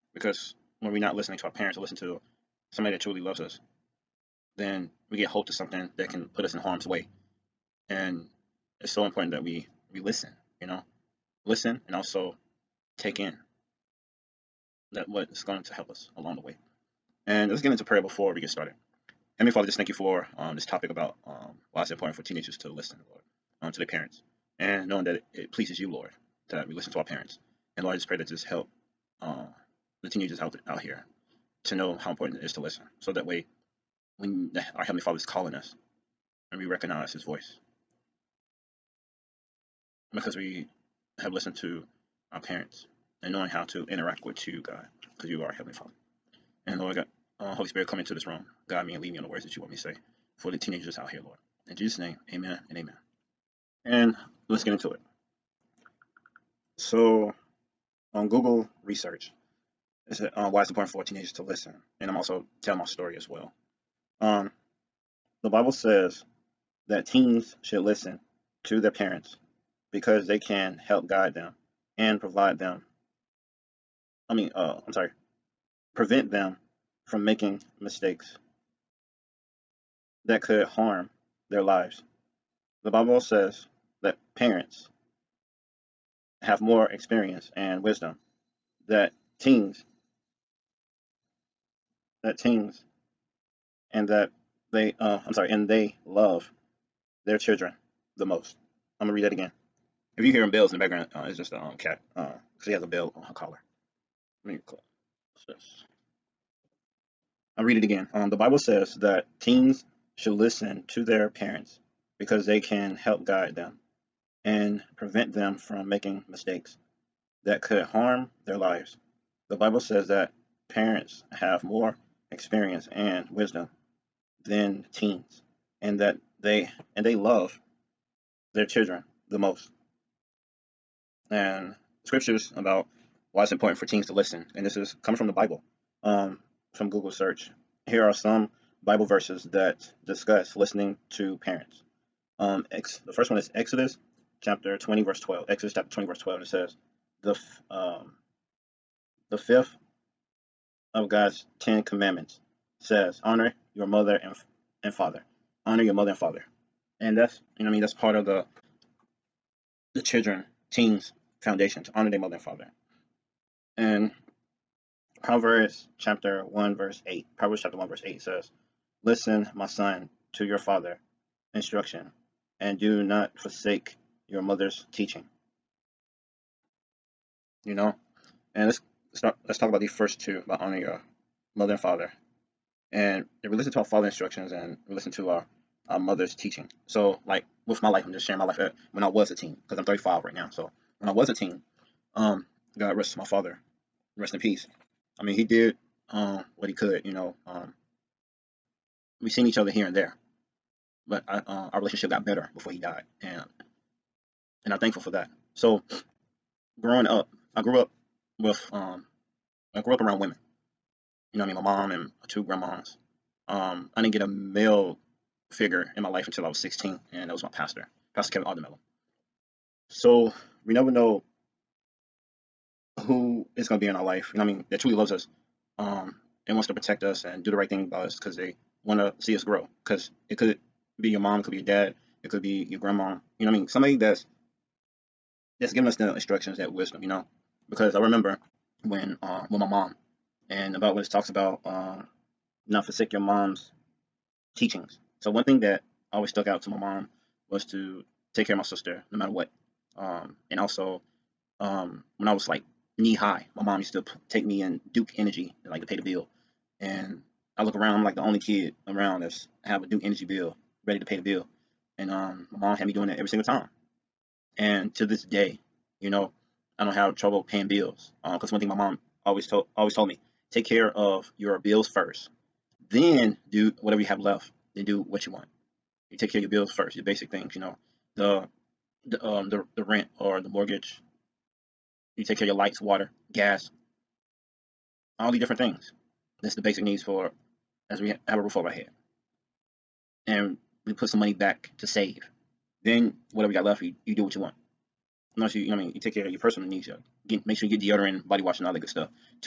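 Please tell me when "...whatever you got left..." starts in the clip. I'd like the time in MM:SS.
04:53.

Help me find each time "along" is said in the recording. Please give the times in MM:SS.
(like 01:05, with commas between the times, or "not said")
00:16.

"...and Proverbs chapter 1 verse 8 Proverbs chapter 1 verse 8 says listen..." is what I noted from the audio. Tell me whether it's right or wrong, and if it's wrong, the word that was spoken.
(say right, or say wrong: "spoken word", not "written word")
right.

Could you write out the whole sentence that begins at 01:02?
And I'm also tell my story as well.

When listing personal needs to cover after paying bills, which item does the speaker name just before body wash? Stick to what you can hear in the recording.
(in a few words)
deodorant.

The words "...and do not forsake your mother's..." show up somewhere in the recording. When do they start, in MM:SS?
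02:52.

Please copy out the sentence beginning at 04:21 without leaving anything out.
And um, my mom had me doing that every single time.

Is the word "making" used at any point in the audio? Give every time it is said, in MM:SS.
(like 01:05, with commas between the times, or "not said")
01:17, 01:55.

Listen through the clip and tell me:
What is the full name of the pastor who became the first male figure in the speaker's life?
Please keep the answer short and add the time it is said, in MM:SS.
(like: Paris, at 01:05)
Kevin Aldermello, at 03:38.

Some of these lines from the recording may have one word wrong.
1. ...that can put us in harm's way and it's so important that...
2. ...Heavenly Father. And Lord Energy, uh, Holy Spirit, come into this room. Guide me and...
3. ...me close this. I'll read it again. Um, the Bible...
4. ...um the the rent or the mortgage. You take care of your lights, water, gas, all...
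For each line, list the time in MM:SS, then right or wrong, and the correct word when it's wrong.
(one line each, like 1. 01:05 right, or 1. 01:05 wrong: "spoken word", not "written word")
1. 00:05 right
2. 00:45 wrong: "God", not "Energy"
3. 01:44 right
4. 04:39 right.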